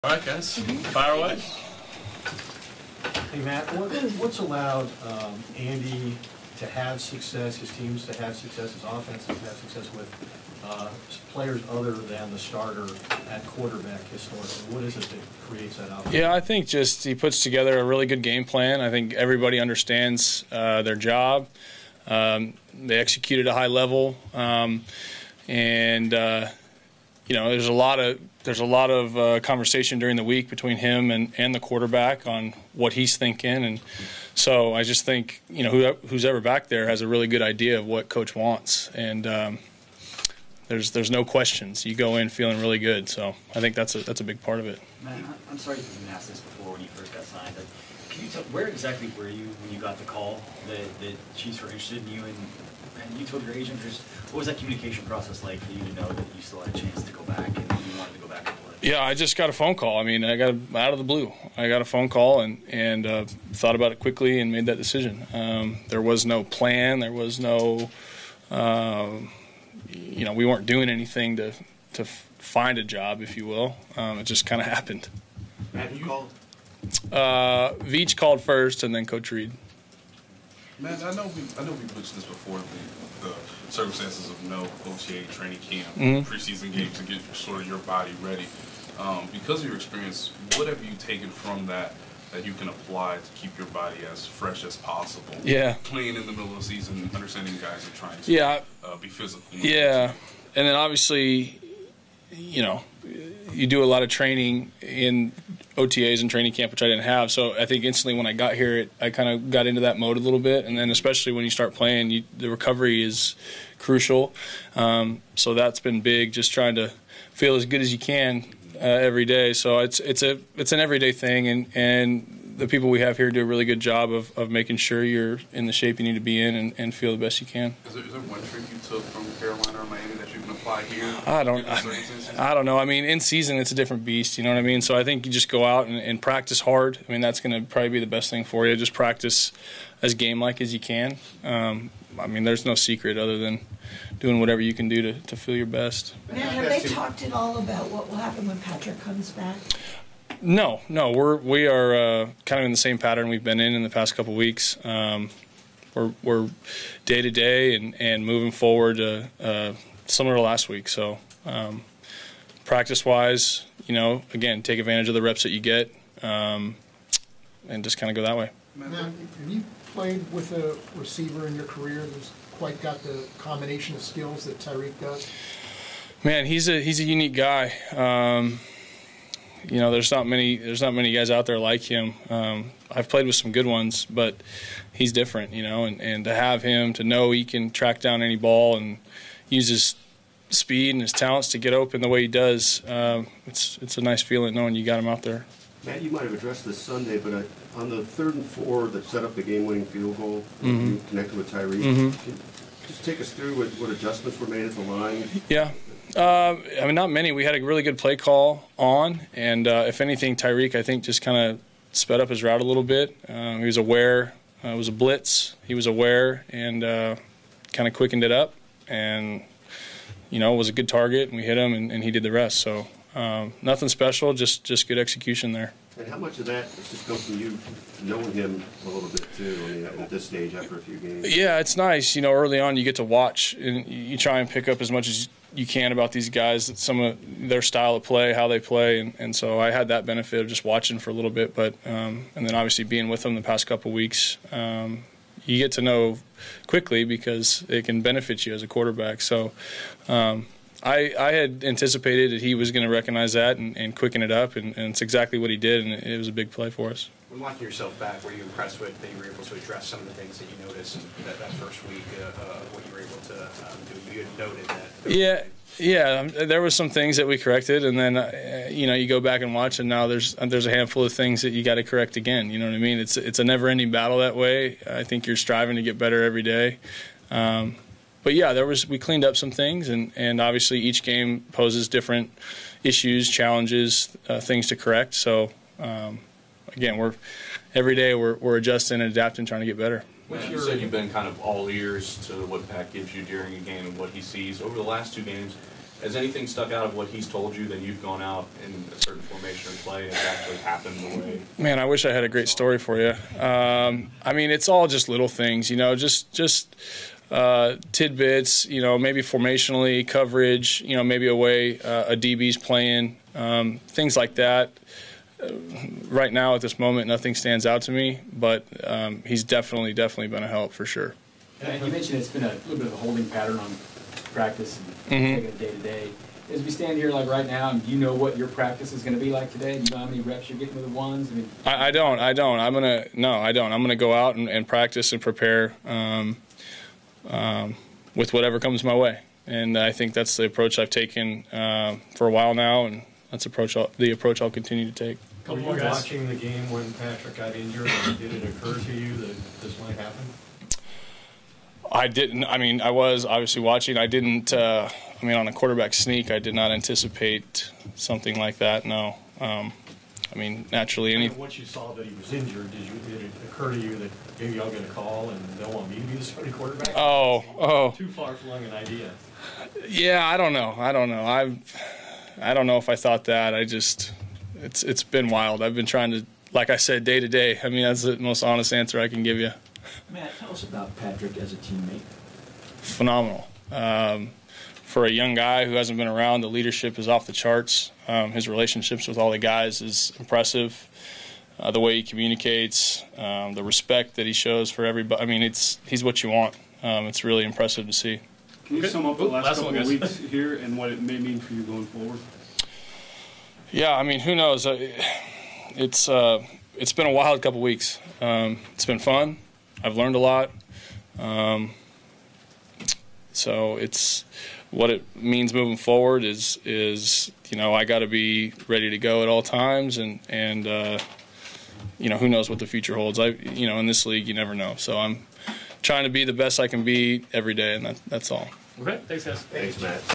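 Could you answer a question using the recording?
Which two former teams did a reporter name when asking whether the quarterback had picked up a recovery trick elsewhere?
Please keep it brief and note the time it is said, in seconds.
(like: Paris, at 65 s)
Carolina or Miami, at 129 s.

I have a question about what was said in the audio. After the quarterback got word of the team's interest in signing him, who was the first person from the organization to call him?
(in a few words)
Veach.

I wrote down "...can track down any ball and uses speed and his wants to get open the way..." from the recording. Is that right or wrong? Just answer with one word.
wrong.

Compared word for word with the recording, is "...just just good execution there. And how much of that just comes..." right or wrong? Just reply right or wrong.
right.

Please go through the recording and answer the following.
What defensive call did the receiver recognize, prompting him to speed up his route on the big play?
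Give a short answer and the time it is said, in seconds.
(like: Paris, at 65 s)
a blitz, at 214 s.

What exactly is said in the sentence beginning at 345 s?
Were you watching the game when Patrick got injured?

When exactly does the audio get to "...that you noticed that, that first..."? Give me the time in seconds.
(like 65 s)
260 s.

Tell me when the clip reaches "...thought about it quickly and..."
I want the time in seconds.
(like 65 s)
63 s.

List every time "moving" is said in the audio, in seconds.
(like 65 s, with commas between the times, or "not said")
158 s, 415 s.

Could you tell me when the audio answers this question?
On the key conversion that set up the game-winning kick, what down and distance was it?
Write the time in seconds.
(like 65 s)
198 s.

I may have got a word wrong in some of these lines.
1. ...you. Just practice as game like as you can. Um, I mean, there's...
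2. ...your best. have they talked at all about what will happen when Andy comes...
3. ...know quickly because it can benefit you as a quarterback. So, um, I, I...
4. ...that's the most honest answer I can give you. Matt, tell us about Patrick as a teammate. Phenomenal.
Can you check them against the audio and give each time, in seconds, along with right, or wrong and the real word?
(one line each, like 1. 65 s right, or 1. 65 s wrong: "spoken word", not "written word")
1. 138 s right
2. 145 s wrong: "Patrick", not "Andy"
3. 245 s right
4. 377 s right.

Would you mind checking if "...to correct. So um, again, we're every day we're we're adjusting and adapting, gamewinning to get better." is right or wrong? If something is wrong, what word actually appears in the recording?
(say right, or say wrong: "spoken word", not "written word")
wrong: "trying", not "gamewinning".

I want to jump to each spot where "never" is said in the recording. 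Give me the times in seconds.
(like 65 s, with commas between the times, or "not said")
273 s, 424 s.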